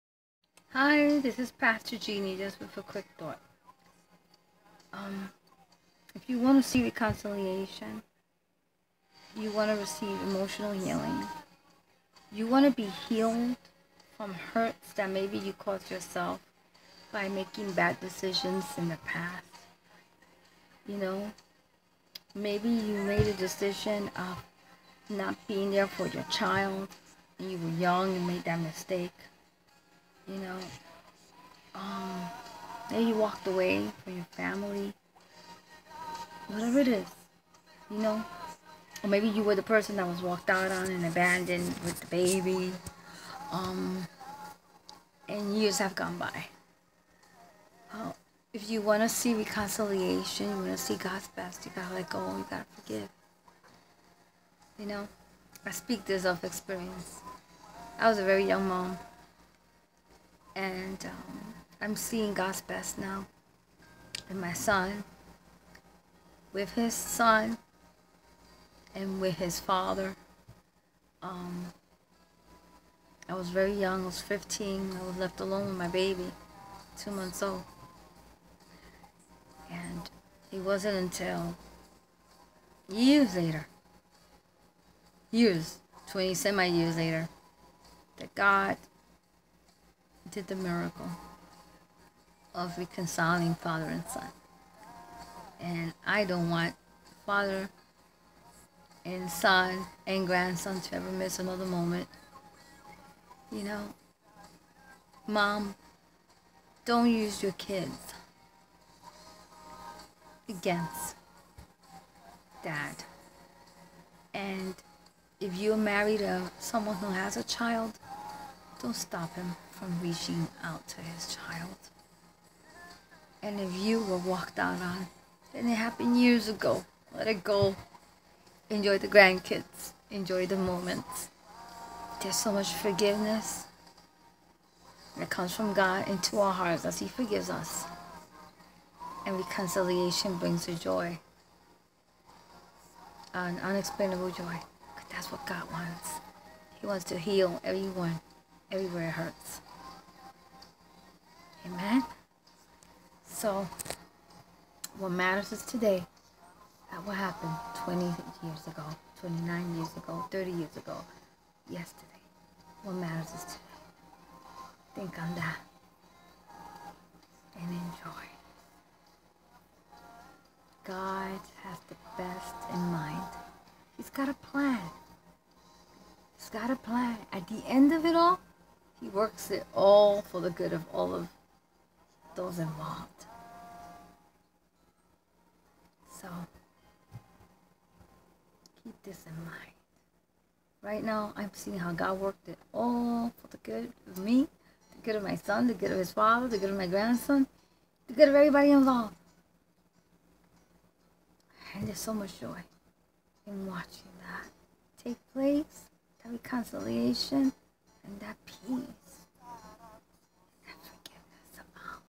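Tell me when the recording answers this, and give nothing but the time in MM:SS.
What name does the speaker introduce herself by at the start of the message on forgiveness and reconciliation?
00:01.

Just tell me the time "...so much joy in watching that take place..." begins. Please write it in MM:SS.
03:21.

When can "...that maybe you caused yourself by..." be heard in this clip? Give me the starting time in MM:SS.
00:14.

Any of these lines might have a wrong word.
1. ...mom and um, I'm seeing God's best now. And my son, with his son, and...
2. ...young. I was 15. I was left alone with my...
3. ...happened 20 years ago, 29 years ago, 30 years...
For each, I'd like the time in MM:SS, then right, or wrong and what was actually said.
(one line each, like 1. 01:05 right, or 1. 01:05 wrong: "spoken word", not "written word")
1. 00:58 right
2. 01:13 right
3. 02:37 right.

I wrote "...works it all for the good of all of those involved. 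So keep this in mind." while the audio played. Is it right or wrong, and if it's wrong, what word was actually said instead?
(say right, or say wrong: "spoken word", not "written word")
right.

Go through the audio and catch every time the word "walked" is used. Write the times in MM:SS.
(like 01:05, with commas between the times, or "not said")
00:33, 00:40, 02:04.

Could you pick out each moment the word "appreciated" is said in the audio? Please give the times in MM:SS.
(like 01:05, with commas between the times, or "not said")
not said.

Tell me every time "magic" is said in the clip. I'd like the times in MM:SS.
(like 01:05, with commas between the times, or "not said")
not said.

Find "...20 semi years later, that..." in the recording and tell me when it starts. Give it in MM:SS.
01:26.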